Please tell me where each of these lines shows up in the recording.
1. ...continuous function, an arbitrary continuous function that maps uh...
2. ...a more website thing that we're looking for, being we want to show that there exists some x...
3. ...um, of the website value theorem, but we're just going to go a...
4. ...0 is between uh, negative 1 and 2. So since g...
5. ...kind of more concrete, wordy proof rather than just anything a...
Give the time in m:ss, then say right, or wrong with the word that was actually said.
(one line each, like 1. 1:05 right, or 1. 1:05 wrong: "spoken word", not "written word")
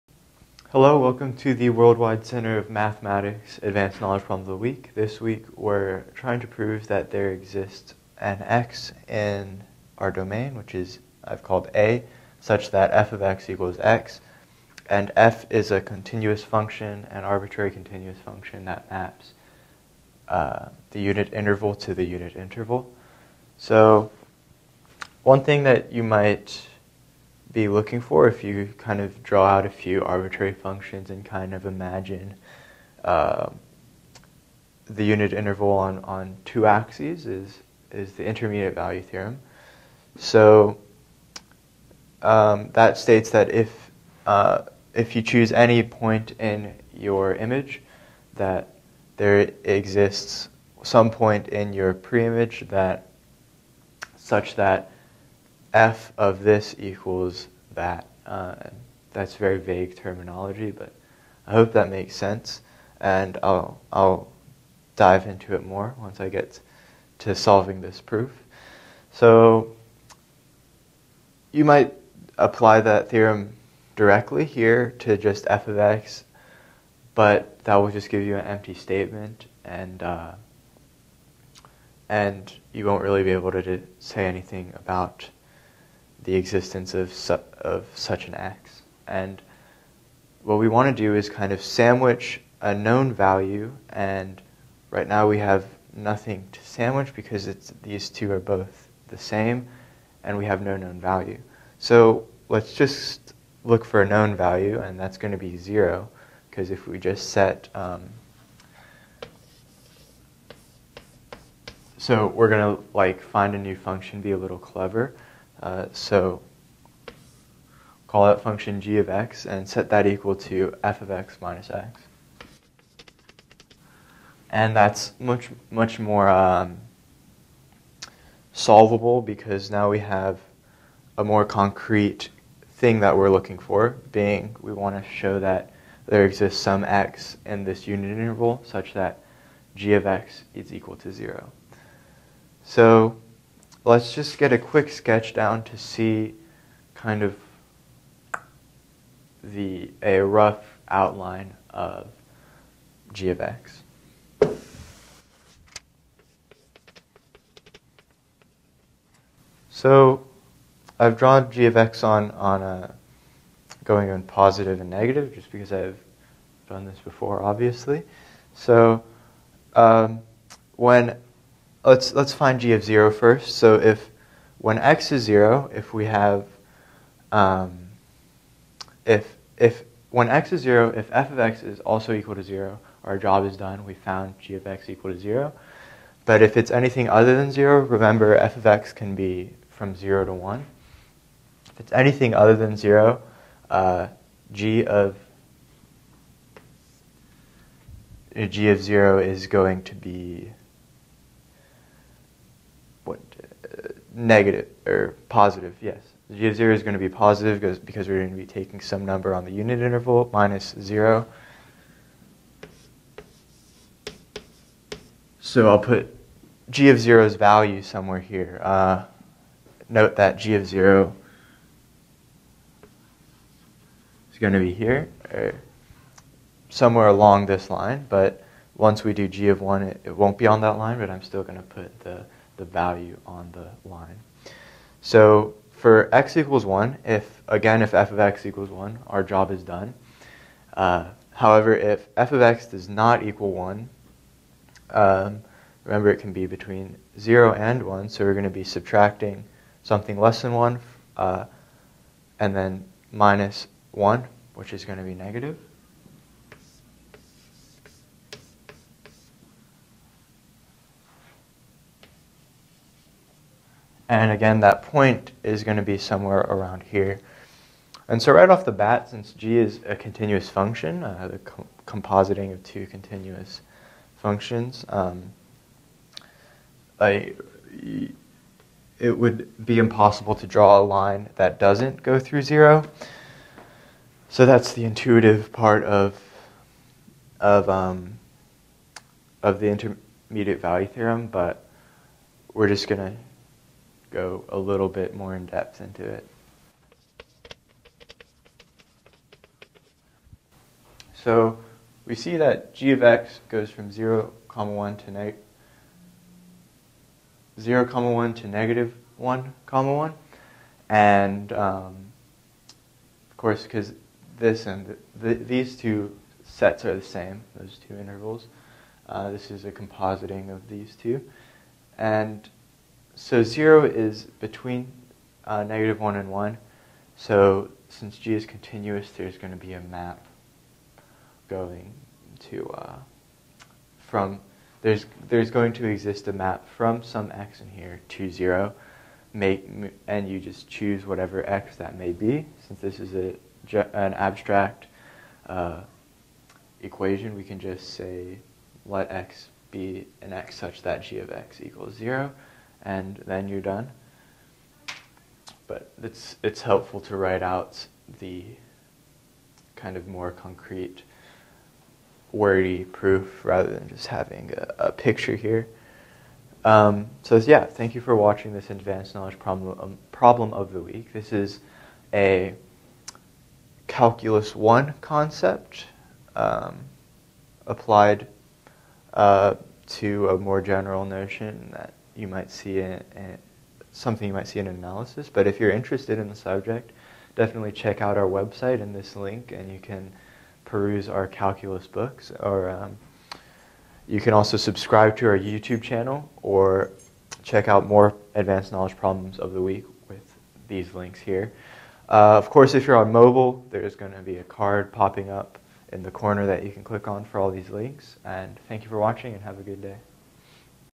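1. 0:15 right
2. 2:11 wrong: "concrete", not "website"
3. 4:47 wrong: "intermediate", not "website"
4. 5:23 wrong: "1", not "2"
5. 5:59 wrong: "having", not "anything".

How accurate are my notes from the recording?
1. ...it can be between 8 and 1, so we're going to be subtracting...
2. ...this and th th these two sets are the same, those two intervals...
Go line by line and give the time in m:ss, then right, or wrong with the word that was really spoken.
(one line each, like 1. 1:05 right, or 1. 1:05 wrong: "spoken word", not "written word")
1. 4:06 wrong: "0", not "8"
2. 5:14 right.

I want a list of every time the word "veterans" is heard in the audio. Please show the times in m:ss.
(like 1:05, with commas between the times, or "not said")
not said.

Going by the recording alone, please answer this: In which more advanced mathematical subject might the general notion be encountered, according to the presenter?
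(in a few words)
Analysis.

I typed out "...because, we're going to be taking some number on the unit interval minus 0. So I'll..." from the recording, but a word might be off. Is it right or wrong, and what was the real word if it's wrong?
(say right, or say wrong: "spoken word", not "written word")
right.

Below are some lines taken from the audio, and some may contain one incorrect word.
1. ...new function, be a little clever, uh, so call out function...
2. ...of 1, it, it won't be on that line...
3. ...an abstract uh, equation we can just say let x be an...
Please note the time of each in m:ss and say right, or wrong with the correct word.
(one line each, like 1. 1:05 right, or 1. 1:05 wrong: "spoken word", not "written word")
1. 1:53 right
2. 3:49 right
3. 5:43 right.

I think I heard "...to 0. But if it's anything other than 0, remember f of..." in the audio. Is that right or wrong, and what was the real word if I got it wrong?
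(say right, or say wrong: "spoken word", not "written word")
right.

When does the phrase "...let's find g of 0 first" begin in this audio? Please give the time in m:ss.
2:52.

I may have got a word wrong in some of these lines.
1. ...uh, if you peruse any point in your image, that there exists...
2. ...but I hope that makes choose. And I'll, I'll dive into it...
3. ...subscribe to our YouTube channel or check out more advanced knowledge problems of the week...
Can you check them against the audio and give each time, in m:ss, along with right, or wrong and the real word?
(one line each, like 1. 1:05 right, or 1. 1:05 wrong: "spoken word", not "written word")
1. 0:44 wrong: "choose", not "peruse"
2. 1:00 wrong: "sense", not "choose"
3. 6:34 right.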